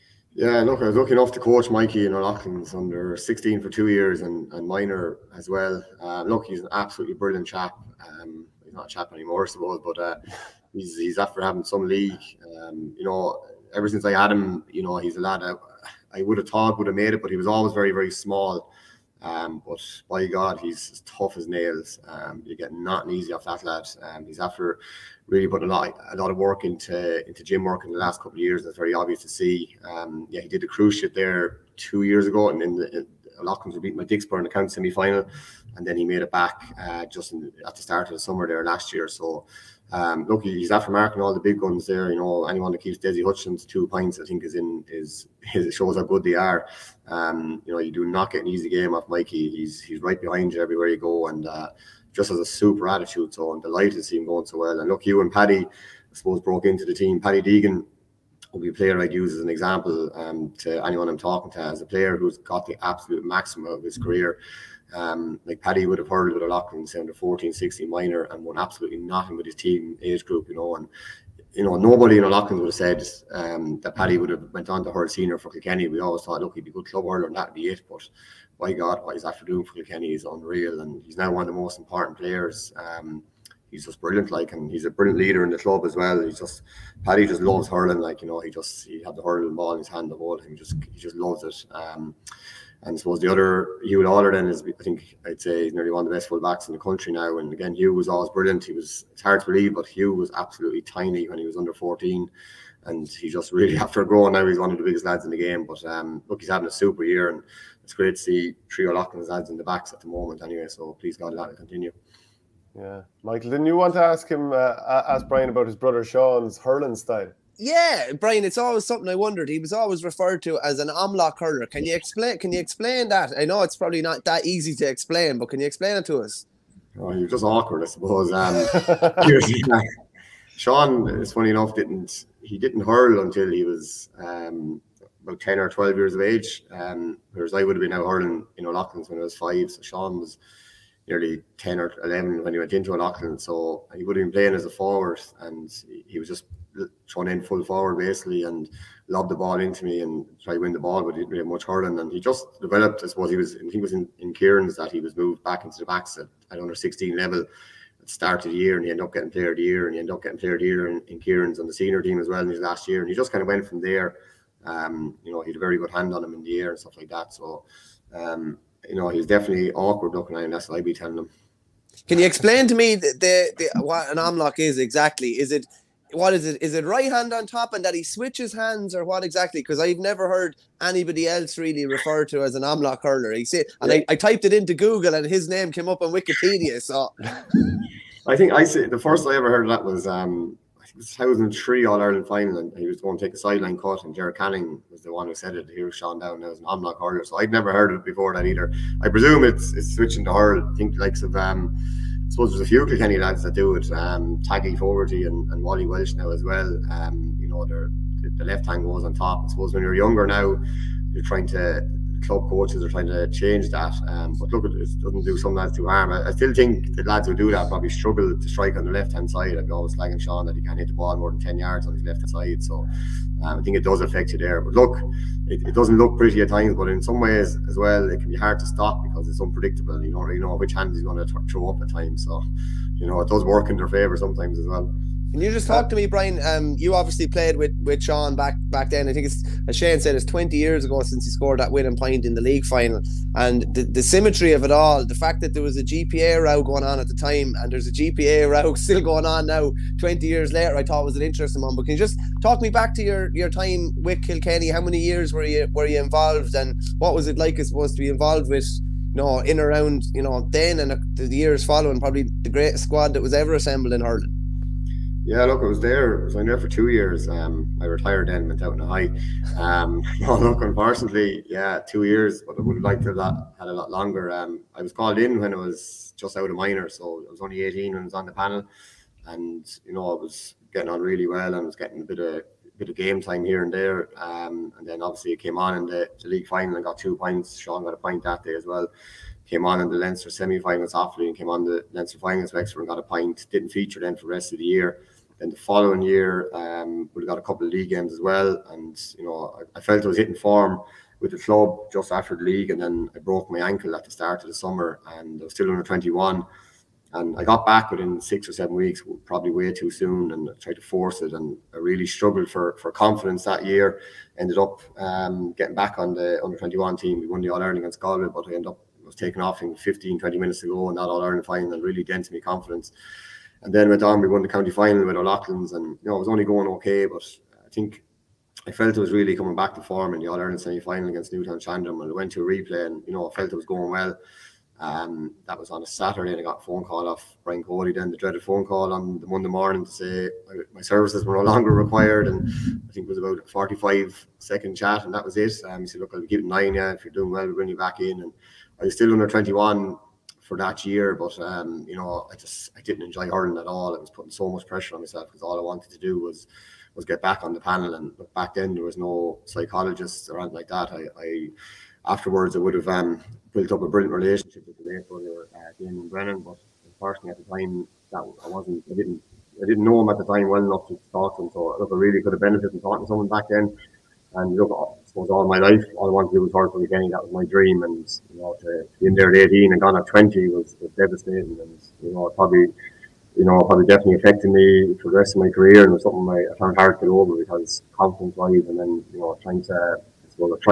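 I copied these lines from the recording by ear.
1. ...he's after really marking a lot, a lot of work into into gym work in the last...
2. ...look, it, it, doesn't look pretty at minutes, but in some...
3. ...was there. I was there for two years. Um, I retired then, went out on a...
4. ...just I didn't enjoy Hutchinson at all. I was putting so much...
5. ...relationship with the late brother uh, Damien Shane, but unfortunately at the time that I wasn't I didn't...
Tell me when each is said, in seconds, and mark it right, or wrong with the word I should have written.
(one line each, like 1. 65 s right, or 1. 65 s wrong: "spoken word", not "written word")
1. 24 s wrong: "putting", not "marking"
2. 224 s wrong: "times", not "minutes"
3. 265 s right
4. 352 s wrong: "Ireland", not "Hutchinson"
5. 364 s wrong: "Brennan", not "Shane".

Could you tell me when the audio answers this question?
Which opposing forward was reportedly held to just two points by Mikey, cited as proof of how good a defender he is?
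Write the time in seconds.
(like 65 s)
42 s.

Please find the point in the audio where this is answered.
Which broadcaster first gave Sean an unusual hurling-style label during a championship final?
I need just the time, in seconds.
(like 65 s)
194 s.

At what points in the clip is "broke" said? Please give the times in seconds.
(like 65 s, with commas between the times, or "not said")
56 s, 303 s.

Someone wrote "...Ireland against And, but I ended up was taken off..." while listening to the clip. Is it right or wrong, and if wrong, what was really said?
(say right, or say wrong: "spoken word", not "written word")
wrong: "Galway", not "And".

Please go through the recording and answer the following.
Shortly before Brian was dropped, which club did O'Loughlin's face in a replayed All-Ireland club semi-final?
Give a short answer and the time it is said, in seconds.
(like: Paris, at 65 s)
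Newtownshandrum, at 331 s.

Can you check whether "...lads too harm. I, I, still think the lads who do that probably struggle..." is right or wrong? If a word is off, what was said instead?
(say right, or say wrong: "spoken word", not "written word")
right.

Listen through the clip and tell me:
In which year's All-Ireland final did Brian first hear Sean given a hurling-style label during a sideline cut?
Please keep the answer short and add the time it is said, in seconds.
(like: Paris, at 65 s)
2003, at 190 s.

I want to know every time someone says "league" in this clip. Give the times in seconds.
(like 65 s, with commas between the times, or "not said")
11 s, 242 s, 286 s, 297 s, 302 s.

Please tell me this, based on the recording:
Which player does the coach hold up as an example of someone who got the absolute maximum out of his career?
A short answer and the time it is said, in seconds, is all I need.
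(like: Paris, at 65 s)
Paddy Deegan, at 57 s.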